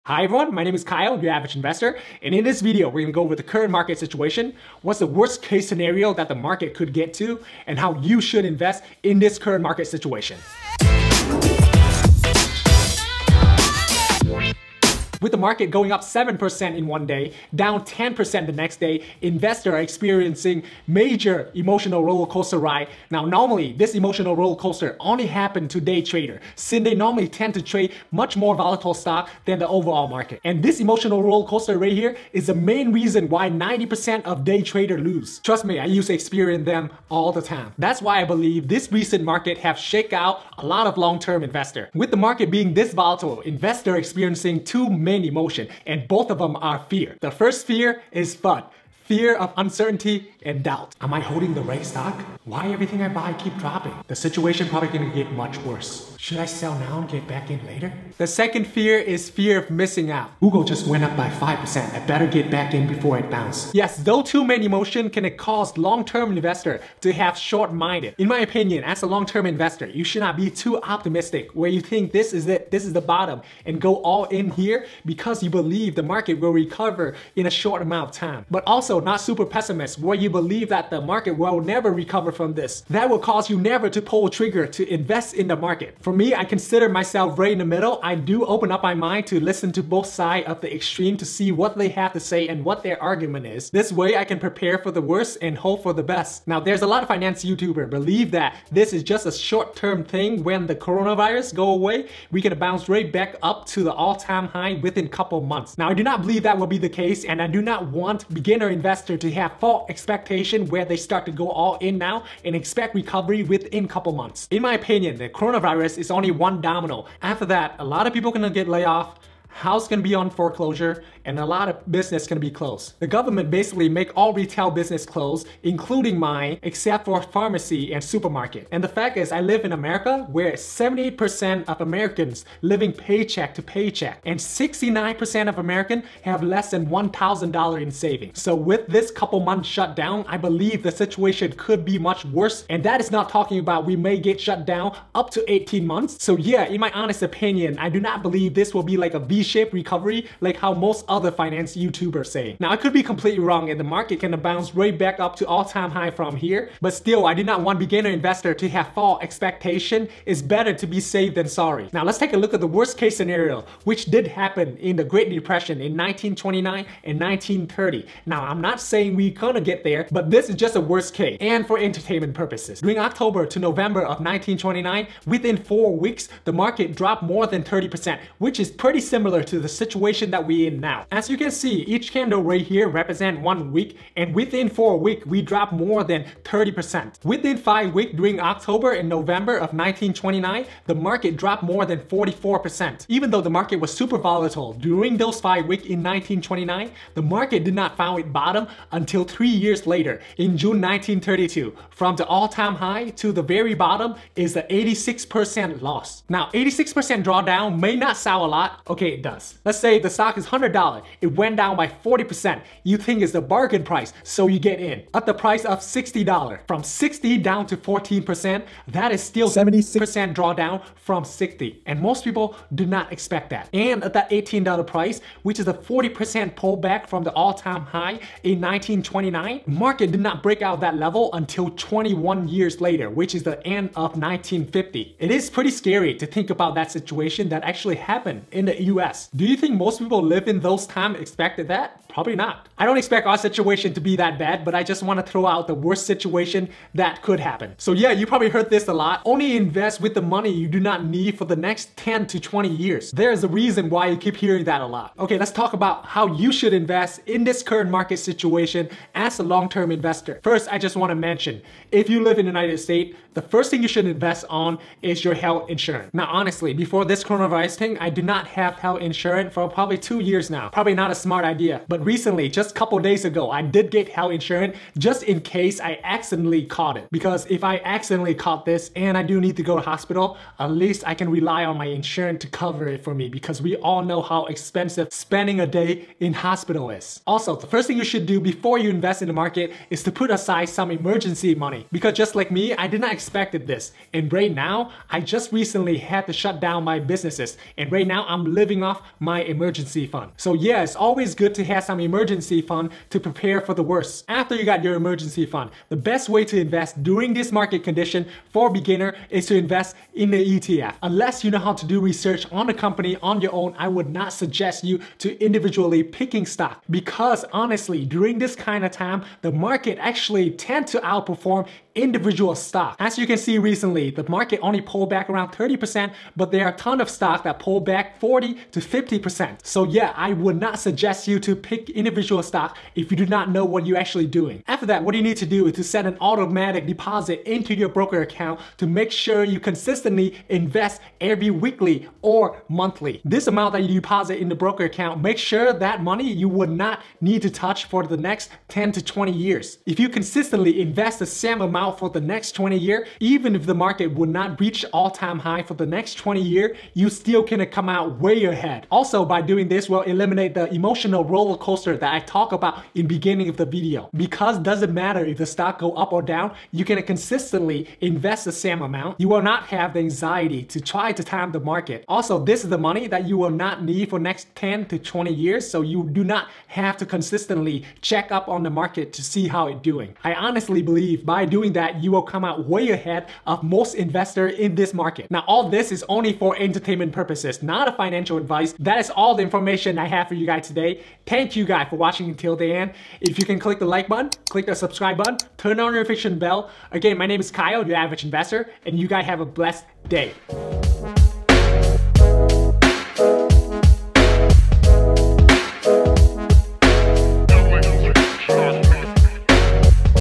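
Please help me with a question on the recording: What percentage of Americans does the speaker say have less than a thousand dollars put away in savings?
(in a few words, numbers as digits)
69%.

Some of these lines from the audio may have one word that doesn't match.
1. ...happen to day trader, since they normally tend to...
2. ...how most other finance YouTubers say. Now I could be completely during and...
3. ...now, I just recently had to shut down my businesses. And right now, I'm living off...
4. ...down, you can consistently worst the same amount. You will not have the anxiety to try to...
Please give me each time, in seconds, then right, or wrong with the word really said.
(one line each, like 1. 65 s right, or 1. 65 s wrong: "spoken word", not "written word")
1. 25 s right
2. 150 s wrong: "wrong", not "during"
3. 294 s right
4. 366 s wrong: "invest", not "worst".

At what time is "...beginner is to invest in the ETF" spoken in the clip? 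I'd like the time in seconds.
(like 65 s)
308 s.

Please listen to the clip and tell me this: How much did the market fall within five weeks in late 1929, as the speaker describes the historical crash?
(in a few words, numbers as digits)
more than 44%.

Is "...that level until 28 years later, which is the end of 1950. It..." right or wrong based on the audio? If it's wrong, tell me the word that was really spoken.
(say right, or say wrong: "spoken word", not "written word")
wrong: "21", not "28".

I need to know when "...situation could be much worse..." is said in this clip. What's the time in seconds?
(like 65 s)
140 s.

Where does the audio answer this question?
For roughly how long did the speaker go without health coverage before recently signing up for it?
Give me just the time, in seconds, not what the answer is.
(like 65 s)
269 s.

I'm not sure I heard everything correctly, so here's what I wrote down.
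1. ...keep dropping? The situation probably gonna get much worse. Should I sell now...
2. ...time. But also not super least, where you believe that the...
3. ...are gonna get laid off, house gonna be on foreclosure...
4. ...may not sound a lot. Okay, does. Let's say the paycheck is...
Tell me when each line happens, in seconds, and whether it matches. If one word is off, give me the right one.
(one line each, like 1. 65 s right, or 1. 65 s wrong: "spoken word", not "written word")
1. 53 s right
2. 78 s wrong: "pessimist", not "least"
3. 118 s right
4. 207 s wrong: "stock", not "paycheck".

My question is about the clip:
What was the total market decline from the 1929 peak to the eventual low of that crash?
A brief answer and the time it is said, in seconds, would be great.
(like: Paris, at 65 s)
86%, at 204 s.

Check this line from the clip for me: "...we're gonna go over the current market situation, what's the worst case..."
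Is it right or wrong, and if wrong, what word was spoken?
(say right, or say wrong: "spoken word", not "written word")
right.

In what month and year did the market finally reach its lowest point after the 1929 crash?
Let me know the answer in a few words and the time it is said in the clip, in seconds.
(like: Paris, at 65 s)
June 1932, at 200 s.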